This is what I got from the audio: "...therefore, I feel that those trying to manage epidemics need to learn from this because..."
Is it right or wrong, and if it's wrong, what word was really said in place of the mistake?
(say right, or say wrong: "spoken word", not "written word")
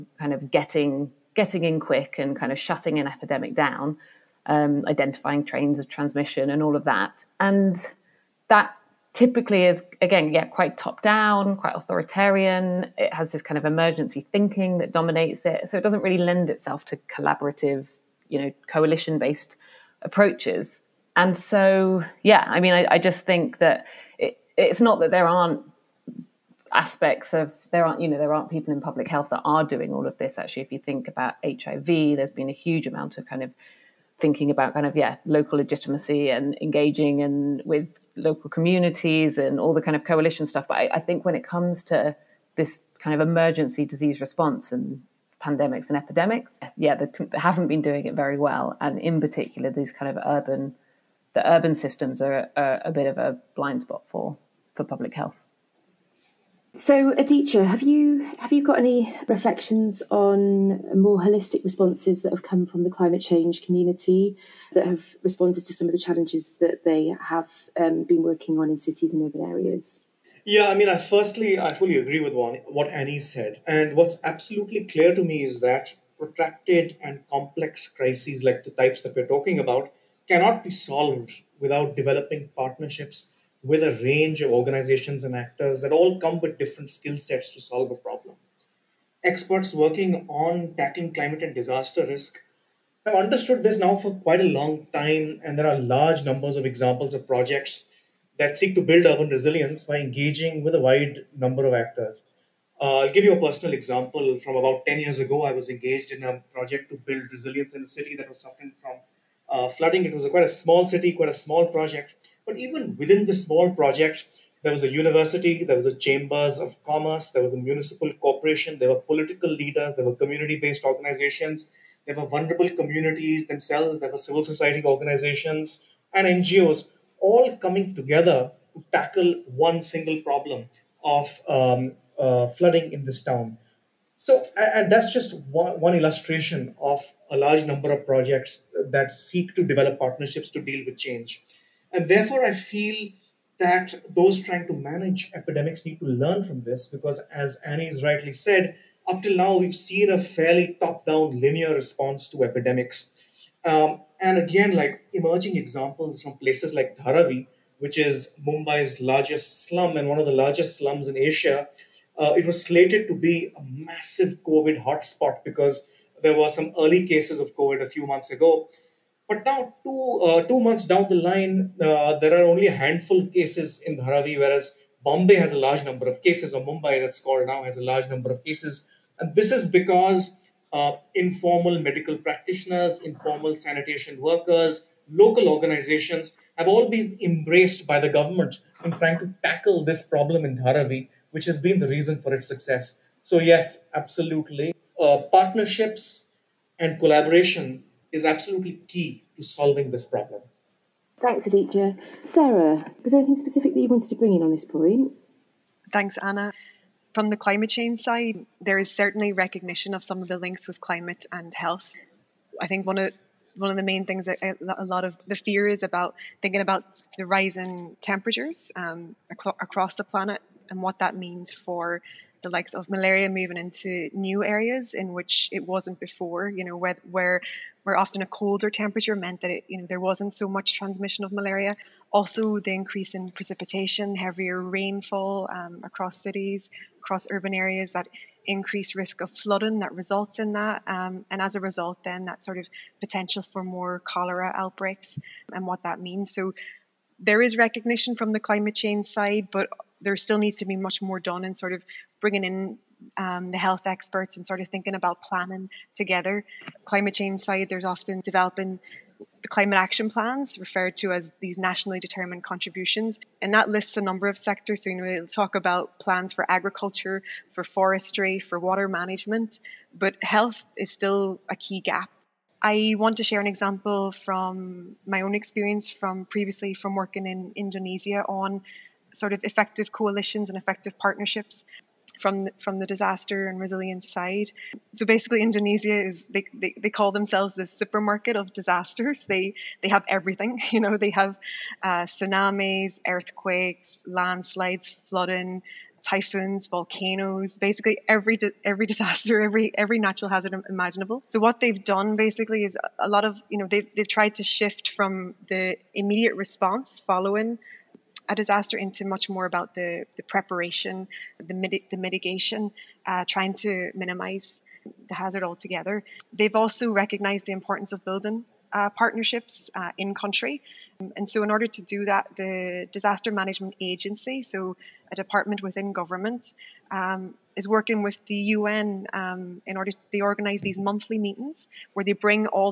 right.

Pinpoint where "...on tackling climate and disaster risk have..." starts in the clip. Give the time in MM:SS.
01:30.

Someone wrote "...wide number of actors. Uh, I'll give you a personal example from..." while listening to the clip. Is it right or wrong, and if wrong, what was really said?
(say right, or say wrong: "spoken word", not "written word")
right.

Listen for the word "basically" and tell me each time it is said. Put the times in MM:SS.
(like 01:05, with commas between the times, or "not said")
04:45, 04:57, 05:02.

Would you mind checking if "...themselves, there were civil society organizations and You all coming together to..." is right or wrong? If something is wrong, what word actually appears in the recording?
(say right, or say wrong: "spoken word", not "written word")
wrong: "NGOs", not "You".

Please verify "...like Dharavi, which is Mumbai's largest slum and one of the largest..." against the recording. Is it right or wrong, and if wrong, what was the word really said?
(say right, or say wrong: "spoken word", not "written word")
right.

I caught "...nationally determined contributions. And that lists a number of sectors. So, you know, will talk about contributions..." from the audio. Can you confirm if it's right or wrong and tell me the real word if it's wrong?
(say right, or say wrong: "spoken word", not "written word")
wrong: "plans", not "contributions".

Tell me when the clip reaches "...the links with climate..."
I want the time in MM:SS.
03:30.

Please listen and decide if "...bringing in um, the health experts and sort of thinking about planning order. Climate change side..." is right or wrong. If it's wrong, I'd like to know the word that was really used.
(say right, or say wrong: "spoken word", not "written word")
wrong: "together", not "order".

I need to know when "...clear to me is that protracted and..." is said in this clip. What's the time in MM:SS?
01:14.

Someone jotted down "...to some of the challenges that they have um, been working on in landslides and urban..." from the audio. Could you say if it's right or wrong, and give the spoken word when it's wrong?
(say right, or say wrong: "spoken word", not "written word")
wrong: "cities", not "landslides".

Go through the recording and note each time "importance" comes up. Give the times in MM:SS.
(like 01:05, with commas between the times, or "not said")
05:17.